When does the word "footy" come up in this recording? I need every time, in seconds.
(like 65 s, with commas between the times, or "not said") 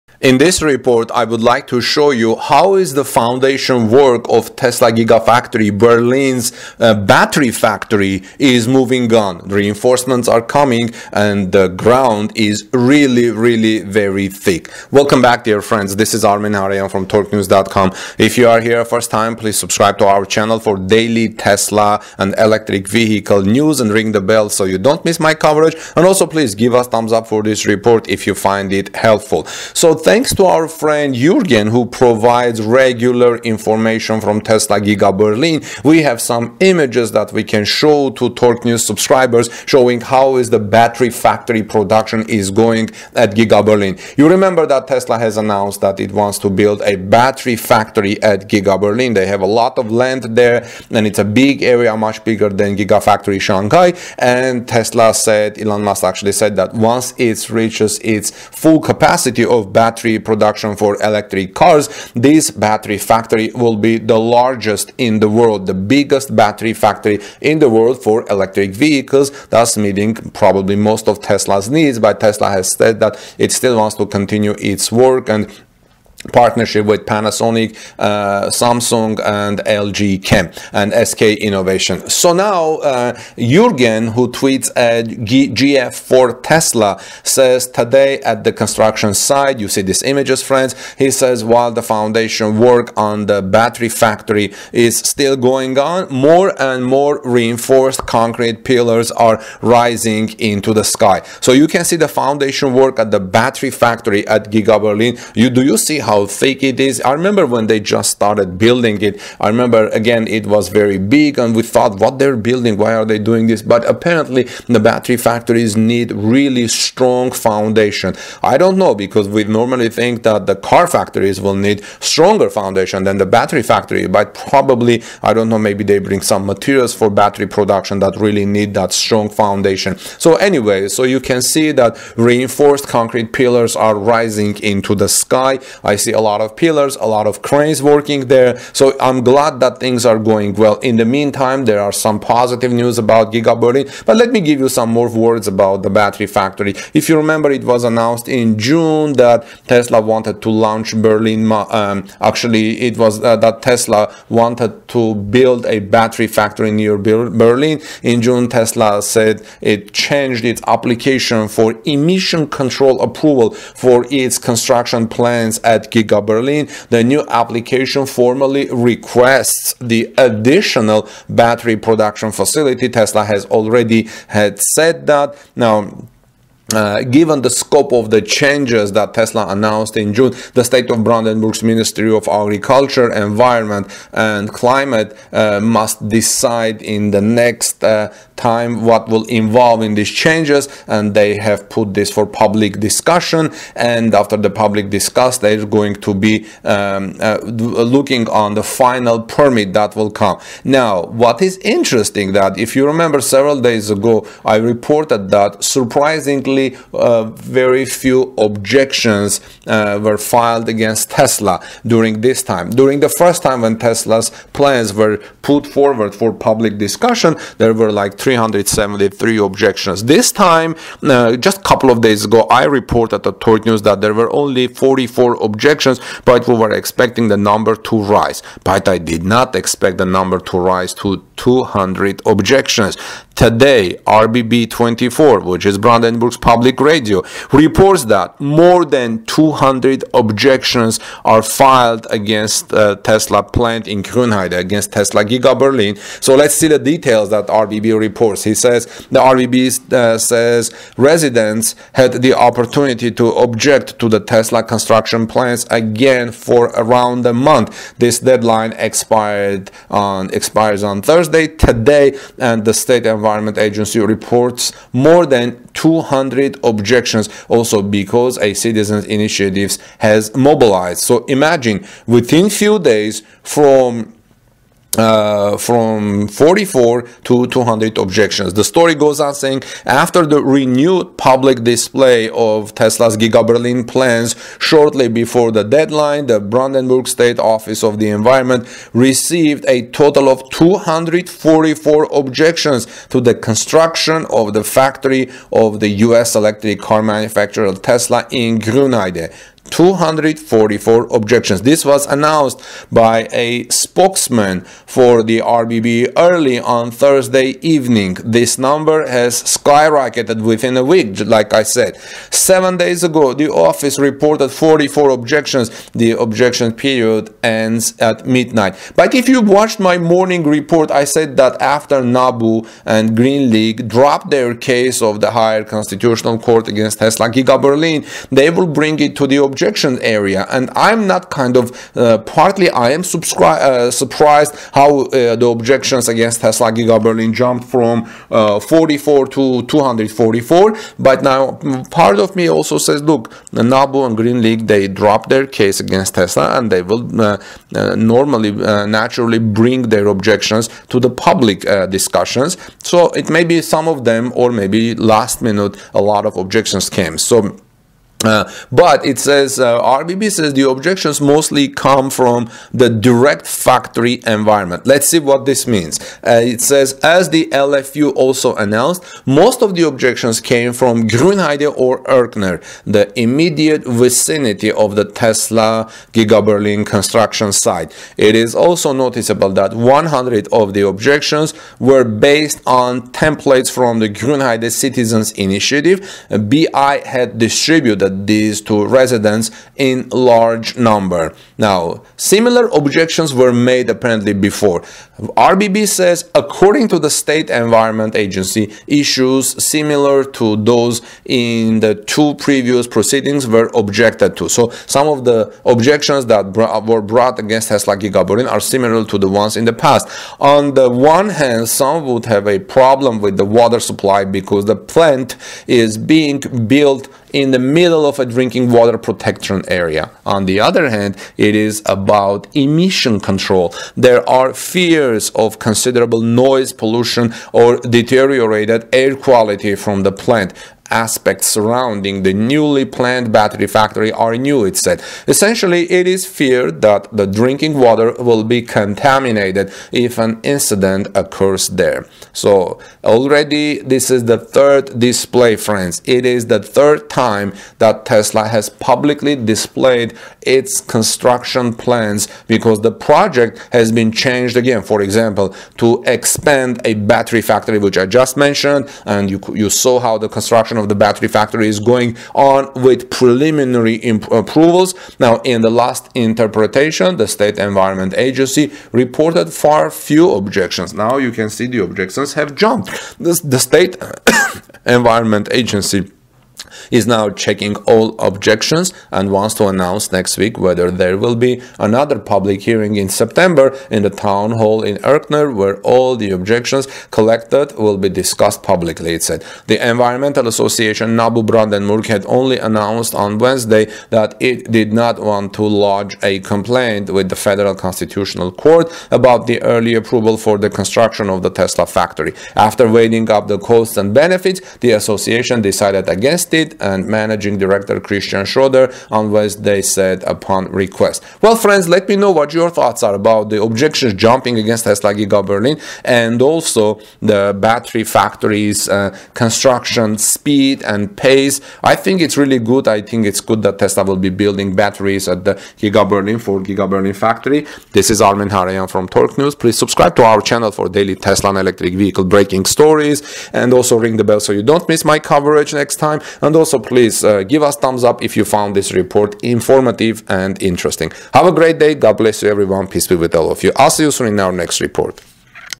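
not said.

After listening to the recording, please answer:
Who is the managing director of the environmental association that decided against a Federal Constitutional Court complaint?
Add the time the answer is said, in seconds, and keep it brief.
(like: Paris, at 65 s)
Christian Schroeder, at 507 s.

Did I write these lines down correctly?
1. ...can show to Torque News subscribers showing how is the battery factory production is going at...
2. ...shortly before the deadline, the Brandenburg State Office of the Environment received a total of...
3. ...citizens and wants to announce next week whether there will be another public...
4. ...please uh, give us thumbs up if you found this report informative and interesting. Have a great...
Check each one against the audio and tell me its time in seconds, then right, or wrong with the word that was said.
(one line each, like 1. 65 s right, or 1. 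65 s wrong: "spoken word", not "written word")
1. 37 s right
2. 284 s right
3. 478 s wrong: "objections", not "citizens"
4. 536 s right.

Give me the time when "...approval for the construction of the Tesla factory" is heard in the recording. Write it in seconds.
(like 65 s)
499 s.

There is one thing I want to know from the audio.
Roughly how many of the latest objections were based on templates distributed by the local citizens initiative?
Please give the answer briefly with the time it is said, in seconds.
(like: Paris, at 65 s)
100, at 379 s.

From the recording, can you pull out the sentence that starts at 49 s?
They have a lot of land there and it's a big area, much bigger than Gigafactory Shanghai.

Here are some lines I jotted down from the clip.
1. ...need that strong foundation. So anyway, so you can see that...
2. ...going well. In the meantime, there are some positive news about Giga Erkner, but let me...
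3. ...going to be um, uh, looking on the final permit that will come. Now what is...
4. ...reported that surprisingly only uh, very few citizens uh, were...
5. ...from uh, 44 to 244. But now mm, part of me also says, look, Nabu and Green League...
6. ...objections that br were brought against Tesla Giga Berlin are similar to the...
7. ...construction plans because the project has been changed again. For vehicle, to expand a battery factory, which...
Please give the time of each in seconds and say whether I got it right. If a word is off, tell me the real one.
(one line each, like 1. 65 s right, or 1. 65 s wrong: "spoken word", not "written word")
1. 128 s right
2. 140 s wrong: "Berlin", not "Erkner"
3. 195 s right
4. 204 s wrong: "objections", not "citizens"
5. 337 s right
6. 405 s right
7. 450 s wrong: "example", not "vehicle".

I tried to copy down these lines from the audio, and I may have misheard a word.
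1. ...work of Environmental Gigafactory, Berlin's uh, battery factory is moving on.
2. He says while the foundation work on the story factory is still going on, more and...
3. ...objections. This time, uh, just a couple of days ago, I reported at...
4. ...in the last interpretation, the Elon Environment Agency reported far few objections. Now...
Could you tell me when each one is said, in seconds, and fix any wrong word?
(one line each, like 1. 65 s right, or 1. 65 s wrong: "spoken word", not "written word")
1. 3 s wrong: "Tesla", not "Environmental"
2. 90 s wrong: "battery", not "story"
3. 219 s right
4. 465 s wrong: "State", not "Elon".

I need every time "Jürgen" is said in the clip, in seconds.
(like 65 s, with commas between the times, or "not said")
31 s, 83 s.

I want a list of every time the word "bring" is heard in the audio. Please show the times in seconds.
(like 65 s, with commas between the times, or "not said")
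126 s, 328 s, 349 s.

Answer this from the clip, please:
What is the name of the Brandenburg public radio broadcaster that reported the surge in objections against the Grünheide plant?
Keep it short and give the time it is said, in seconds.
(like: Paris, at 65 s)
RBB 24, at 234 s.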